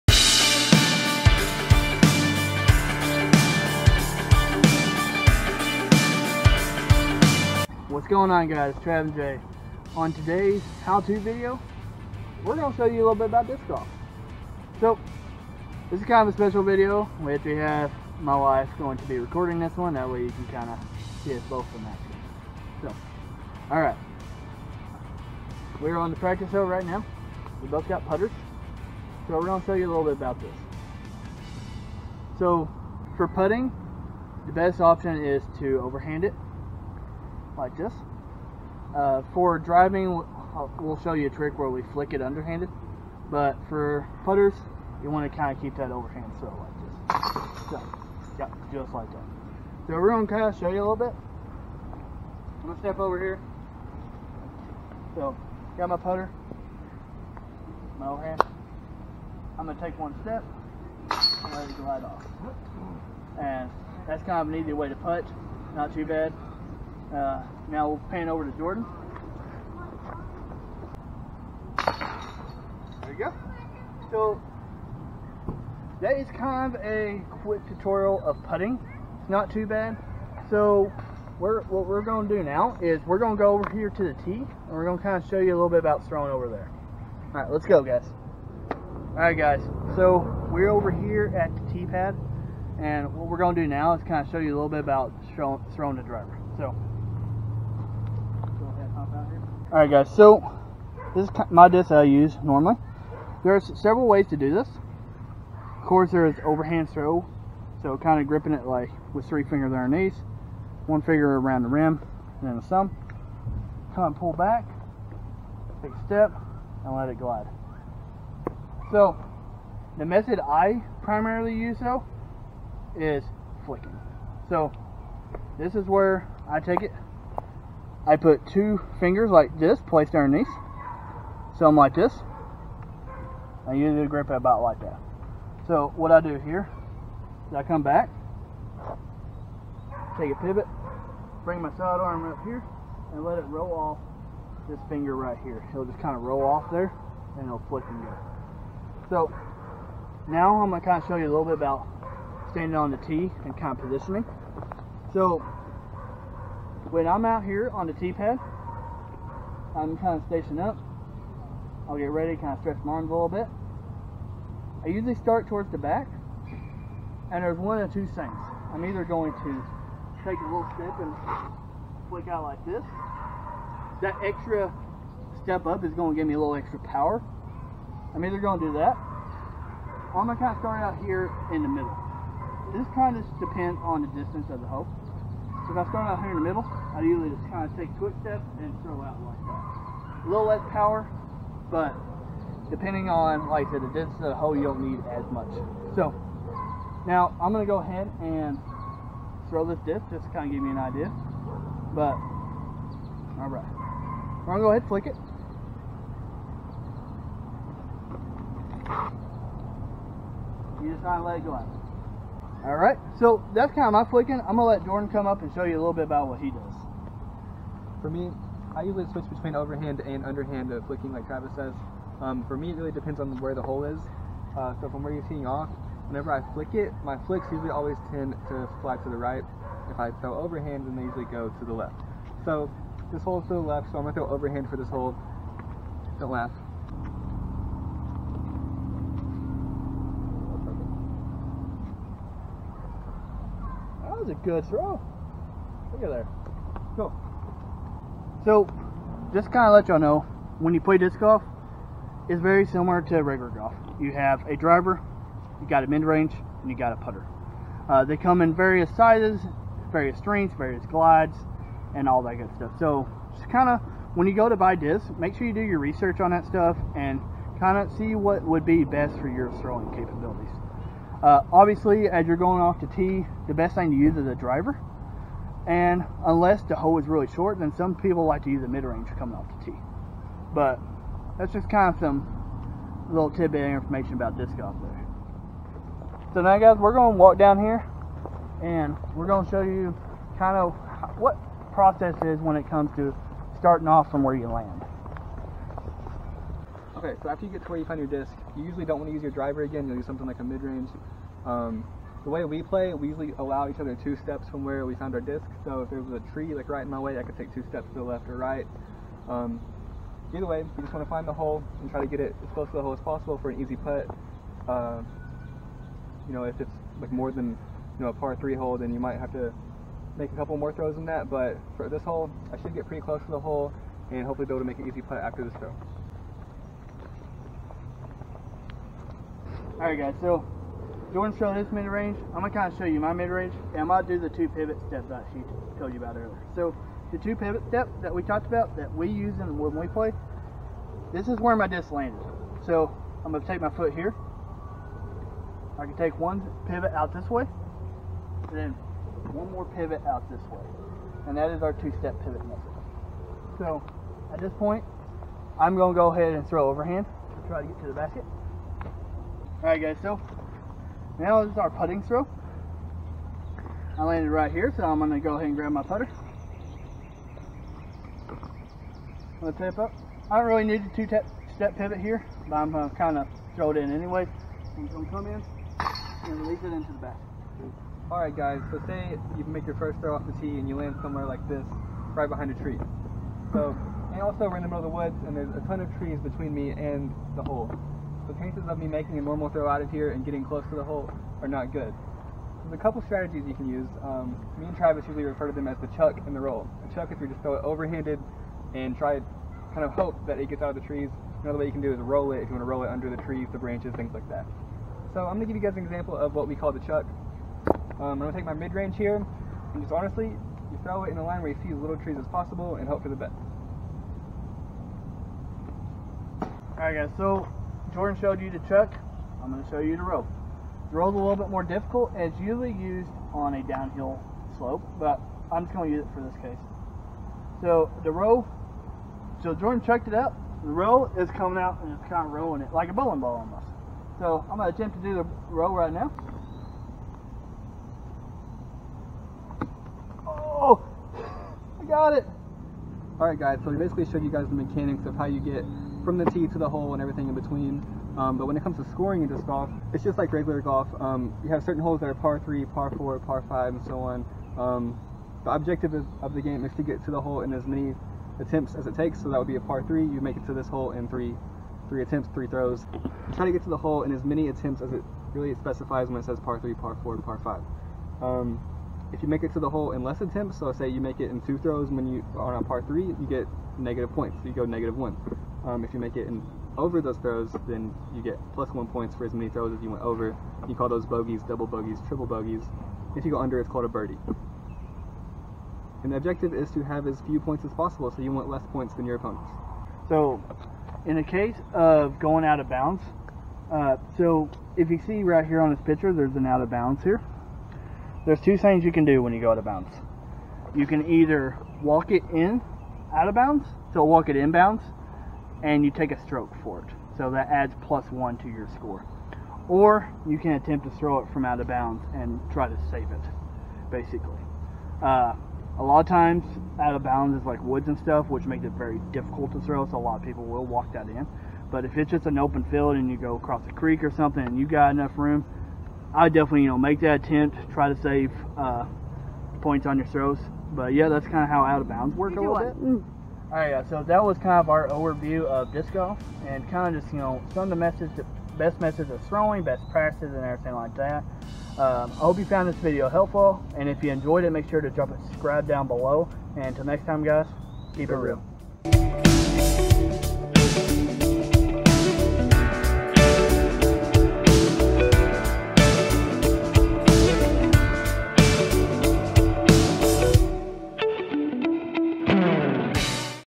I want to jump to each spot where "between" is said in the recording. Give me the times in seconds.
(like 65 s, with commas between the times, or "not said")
219 s, 386 s, 447 s.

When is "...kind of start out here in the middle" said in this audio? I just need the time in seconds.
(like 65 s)
180 s.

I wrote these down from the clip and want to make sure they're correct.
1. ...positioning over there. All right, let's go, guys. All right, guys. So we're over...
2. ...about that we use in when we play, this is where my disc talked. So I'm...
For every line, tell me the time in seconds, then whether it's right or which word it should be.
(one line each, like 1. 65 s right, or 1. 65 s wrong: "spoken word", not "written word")
1. 86 s wrong: "throwing", not "positioning"
2. 338 s wrong: "landed", not "talked".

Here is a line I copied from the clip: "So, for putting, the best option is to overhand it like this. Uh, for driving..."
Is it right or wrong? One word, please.
right.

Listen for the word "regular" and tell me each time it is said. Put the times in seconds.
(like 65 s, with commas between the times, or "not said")
253 s, 450 s.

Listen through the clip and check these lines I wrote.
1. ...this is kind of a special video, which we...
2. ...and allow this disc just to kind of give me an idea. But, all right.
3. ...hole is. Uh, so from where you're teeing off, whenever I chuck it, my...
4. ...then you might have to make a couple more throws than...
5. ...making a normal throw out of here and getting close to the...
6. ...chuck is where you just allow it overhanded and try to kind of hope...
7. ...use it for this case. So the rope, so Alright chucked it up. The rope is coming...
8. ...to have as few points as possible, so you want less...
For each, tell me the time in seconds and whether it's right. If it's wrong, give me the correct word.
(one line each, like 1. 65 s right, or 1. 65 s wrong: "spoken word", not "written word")
1. 15 s right
2. 198 s wrong: "throw", not "allow"
3. 223 s wrong: "flick", not "chuck"
4. 318 s right
5. 388 s right
6. 396 s wrong: "throw", not "allow"
7. 425 s wrong: "Jordan", not "Alright"
8. 486 s right.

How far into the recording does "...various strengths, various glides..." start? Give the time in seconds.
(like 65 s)
259 s.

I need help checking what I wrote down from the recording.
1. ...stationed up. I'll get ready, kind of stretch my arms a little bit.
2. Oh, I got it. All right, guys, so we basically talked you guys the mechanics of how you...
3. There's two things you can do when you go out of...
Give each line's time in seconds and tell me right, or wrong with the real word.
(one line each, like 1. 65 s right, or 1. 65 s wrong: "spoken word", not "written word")
1. 160 s right
2. 440 s wrong: "showed", not "talked"
3. 498 s right.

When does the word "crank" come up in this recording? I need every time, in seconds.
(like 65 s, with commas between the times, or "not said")
not said.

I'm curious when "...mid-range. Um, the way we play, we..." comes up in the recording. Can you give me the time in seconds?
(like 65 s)
300 s.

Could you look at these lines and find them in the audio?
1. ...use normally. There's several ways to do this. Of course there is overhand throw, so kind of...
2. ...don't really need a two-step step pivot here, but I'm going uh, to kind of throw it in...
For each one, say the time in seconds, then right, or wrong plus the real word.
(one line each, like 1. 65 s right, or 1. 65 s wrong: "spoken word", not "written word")
1. 102 s right
2. 370 s right.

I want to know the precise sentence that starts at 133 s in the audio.
I usually grip it about like that.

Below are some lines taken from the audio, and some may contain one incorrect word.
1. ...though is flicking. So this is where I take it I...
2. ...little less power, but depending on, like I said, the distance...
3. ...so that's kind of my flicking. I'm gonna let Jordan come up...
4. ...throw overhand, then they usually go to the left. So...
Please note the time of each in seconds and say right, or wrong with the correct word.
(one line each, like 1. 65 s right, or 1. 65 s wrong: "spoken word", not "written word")
1. 121 s right
2. 190 s right
3. 213 s right
4. 230 s right.